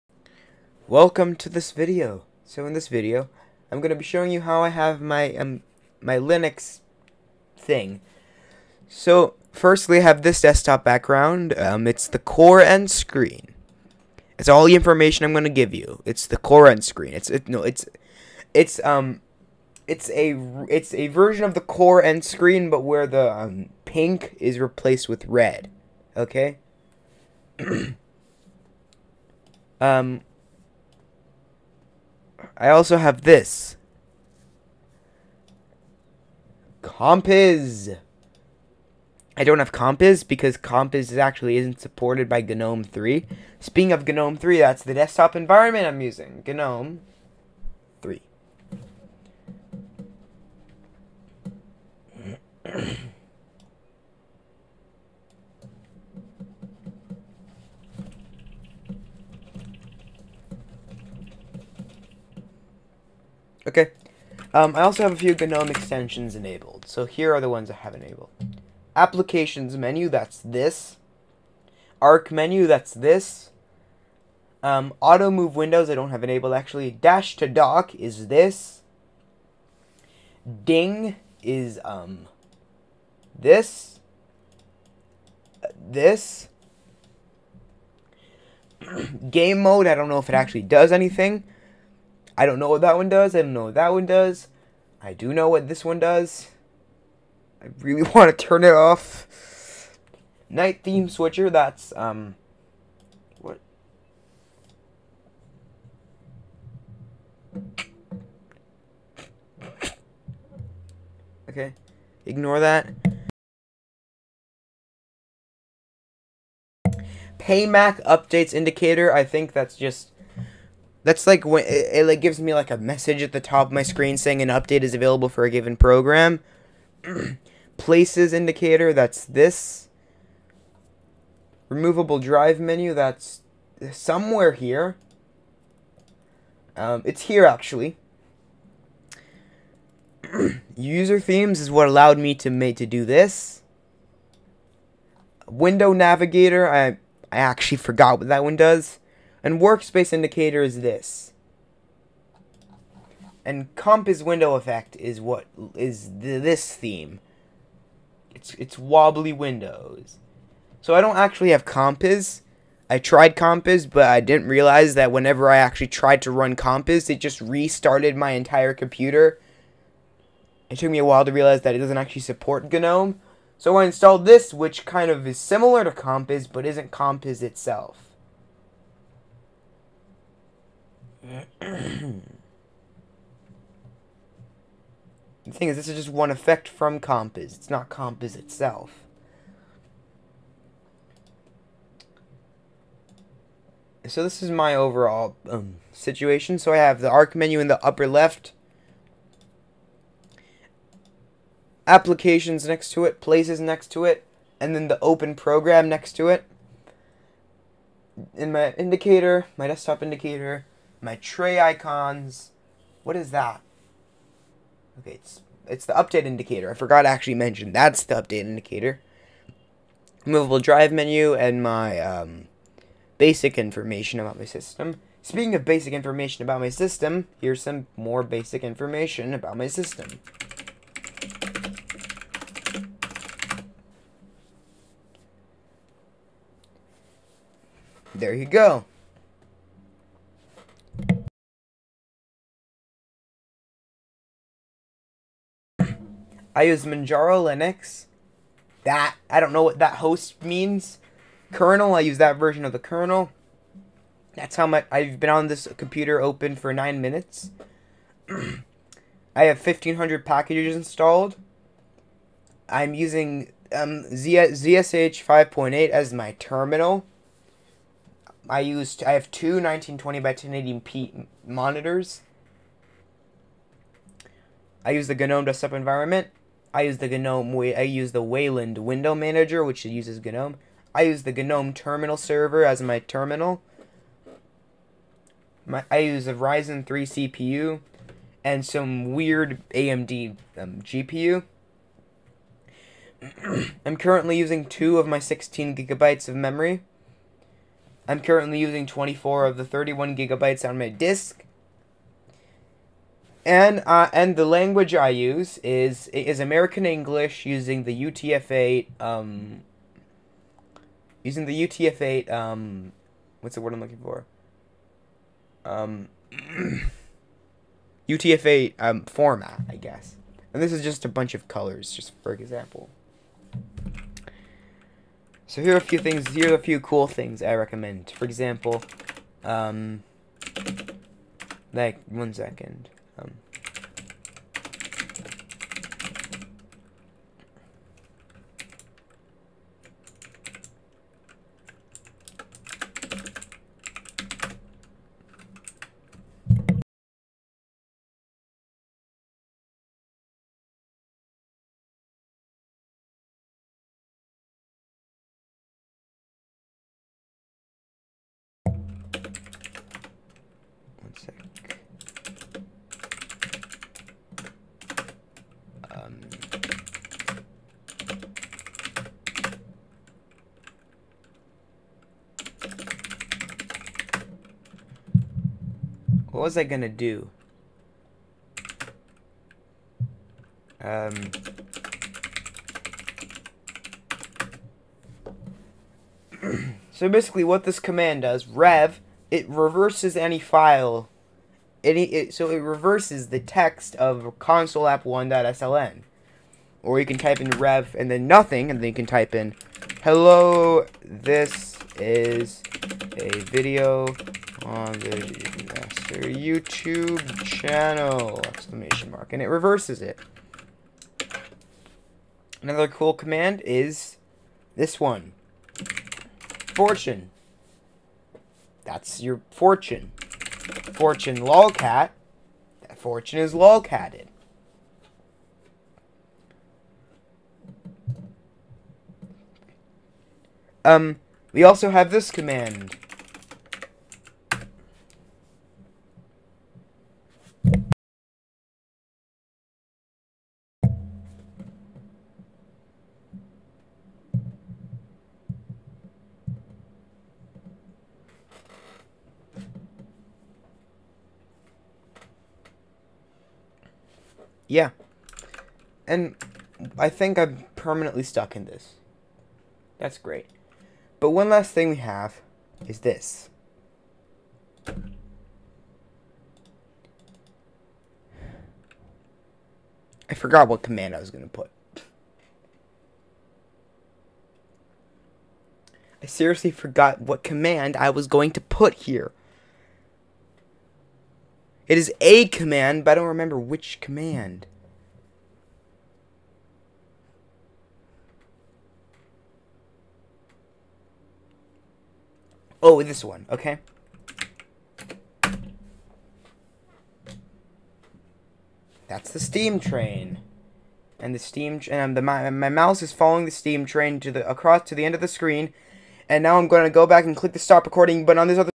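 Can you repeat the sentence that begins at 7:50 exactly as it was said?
I forgot what command I was going to put.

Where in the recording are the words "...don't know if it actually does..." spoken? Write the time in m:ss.
1:29.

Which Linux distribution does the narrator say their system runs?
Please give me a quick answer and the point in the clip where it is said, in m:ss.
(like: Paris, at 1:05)
Manjaro Linux, at 4:06.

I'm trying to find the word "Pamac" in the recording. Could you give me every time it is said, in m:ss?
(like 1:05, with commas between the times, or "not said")
1:57.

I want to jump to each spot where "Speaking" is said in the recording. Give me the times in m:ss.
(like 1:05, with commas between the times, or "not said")
0:43, 3:45.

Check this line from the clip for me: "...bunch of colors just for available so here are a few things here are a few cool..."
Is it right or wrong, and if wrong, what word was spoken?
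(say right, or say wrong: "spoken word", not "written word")
wrong: "example", not "available".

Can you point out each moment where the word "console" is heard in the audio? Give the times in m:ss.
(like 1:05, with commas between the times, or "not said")
6:34.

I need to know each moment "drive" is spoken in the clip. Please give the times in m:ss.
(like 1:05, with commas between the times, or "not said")
2:12, 3:40.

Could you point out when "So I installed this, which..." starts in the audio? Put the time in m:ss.
2:53.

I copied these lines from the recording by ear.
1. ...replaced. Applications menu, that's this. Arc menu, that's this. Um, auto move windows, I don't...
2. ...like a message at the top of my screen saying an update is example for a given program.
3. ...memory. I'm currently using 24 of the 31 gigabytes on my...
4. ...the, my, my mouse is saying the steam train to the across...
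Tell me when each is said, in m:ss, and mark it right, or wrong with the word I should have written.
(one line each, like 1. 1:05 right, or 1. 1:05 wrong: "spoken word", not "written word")
1. 1:07 wrong: "enabled", not "replaced"
2. 2:02 wrong: "available", not "example"
3. 4:56 right
4. 8:22 wrong: "following", not "saying".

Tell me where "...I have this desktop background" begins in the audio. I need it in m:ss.
0:09.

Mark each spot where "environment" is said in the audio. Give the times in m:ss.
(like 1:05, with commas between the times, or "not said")
0:45, 4:35.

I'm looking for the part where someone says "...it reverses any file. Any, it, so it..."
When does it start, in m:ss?
6:29.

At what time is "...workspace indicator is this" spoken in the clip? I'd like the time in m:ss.
2:29.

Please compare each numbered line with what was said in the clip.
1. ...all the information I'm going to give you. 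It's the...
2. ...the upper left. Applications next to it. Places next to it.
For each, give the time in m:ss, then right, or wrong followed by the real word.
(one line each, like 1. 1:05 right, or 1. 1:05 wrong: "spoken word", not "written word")
1. 0:14 right
2. 3:17 right.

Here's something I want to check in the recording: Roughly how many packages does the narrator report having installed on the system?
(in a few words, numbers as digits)
1500.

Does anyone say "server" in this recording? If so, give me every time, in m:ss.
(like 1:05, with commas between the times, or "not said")
4:42.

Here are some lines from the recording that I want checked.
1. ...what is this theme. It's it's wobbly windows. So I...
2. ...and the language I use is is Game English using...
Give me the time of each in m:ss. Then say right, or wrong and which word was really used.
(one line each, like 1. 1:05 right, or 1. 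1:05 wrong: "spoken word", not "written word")
1. 2:35 right
2. 5:04 wrong: "American", not "Game".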